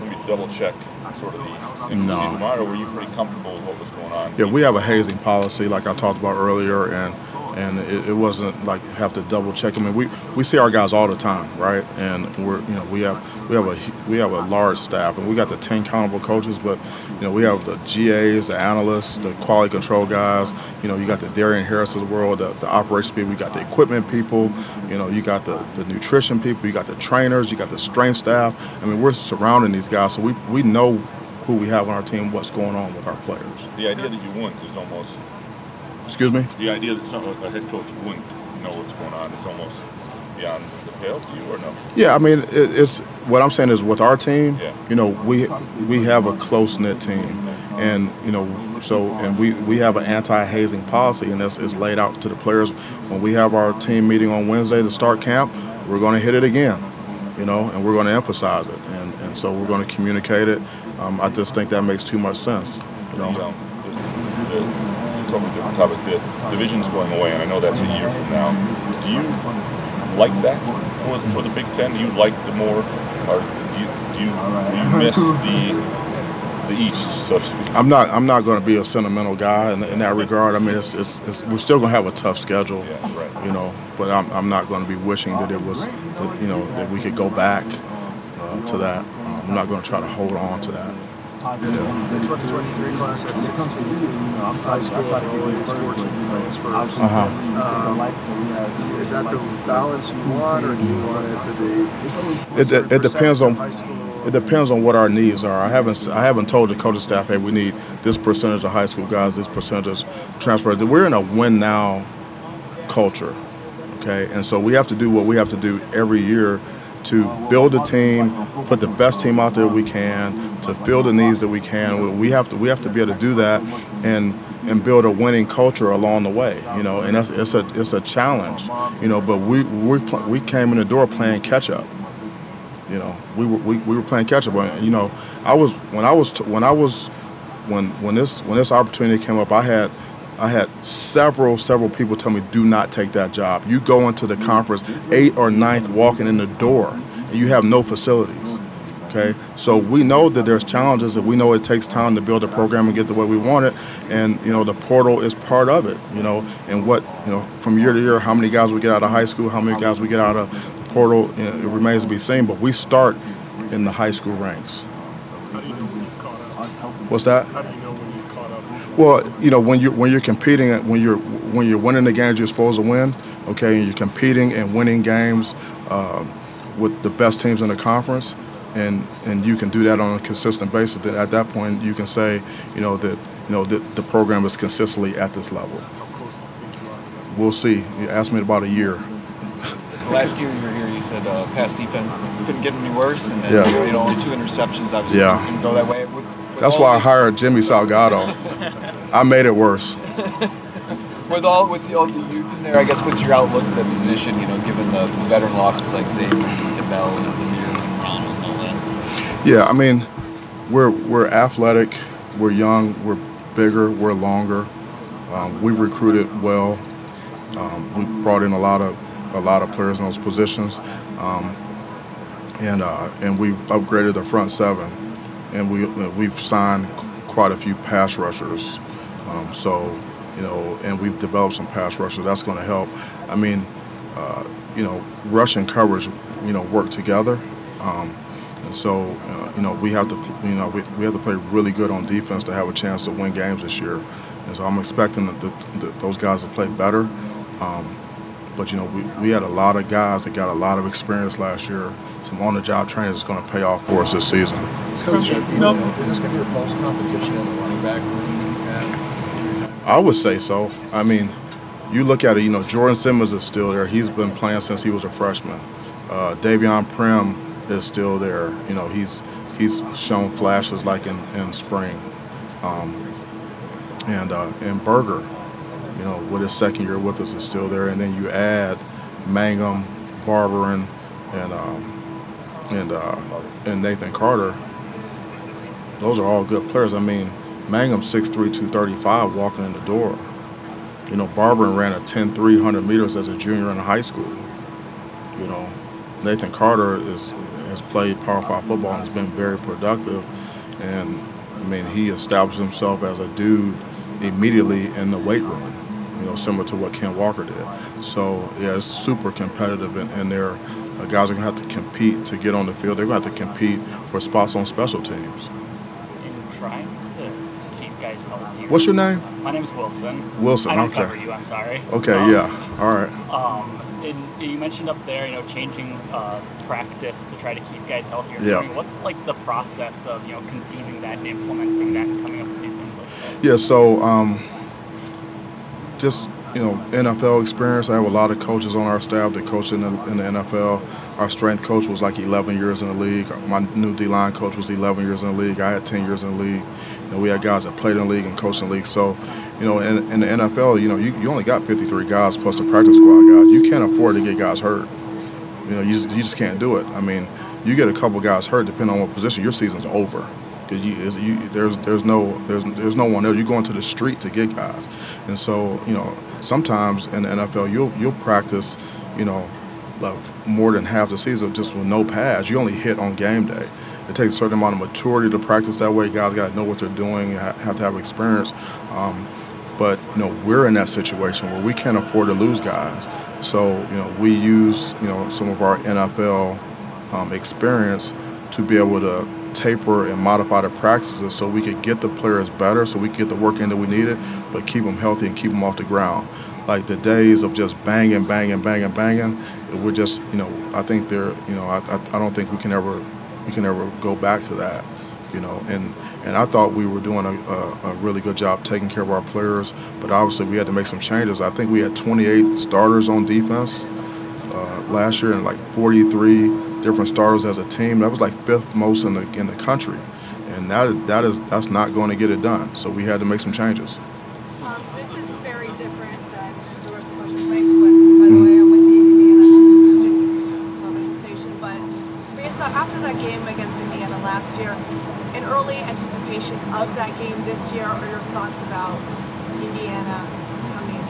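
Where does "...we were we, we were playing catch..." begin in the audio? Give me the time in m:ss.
2:13.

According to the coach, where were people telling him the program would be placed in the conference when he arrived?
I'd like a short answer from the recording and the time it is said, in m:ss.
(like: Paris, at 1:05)
eighth or ninth, at 2:25.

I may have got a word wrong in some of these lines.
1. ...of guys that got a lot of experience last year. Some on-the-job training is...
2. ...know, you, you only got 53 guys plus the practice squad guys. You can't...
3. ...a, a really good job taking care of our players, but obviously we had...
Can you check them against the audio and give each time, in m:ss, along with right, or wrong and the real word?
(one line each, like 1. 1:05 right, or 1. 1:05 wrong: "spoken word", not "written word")
1. 4:09 right
2. 5:50 right
3. 6:47 right.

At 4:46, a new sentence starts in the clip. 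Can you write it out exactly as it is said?
I mean, Mangham 6'3", 235 walking in the door.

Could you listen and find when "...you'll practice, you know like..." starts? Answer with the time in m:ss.
6:07.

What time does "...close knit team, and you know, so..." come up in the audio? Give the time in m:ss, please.
0:46.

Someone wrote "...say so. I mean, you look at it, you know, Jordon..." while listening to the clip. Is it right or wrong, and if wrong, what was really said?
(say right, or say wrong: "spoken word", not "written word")
right.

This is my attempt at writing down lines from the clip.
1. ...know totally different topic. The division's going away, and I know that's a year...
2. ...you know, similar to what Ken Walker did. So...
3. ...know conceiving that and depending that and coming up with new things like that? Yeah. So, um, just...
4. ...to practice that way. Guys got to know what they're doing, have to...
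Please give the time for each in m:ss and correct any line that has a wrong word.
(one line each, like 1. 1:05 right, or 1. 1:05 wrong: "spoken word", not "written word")
1. 1:03 right
2. 5:06 right
3. 5:30 wrong: "implementing", not "depending"
4. 6:15 right.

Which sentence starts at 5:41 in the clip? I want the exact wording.
Our strength coach was like 11 years in the league.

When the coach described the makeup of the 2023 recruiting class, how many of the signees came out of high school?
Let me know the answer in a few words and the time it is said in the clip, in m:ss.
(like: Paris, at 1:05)
14, at 1:35.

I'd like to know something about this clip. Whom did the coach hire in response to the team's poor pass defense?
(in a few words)
Jimmy Salgado.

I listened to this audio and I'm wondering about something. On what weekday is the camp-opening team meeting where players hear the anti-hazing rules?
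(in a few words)
Wednesday.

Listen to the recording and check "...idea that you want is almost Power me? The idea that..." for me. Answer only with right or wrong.
wrong.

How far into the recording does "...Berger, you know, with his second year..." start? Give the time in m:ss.
4:34.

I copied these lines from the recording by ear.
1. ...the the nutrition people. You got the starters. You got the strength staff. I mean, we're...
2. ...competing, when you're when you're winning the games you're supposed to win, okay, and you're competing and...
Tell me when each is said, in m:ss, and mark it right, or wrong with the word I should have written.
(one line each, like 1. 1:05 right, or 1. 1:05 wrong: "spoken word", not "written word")
1. 0:25 wrong: "trainers", not "starters"
2. 2:50 right.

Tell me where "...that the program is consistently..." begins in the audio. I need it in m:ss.
3:03.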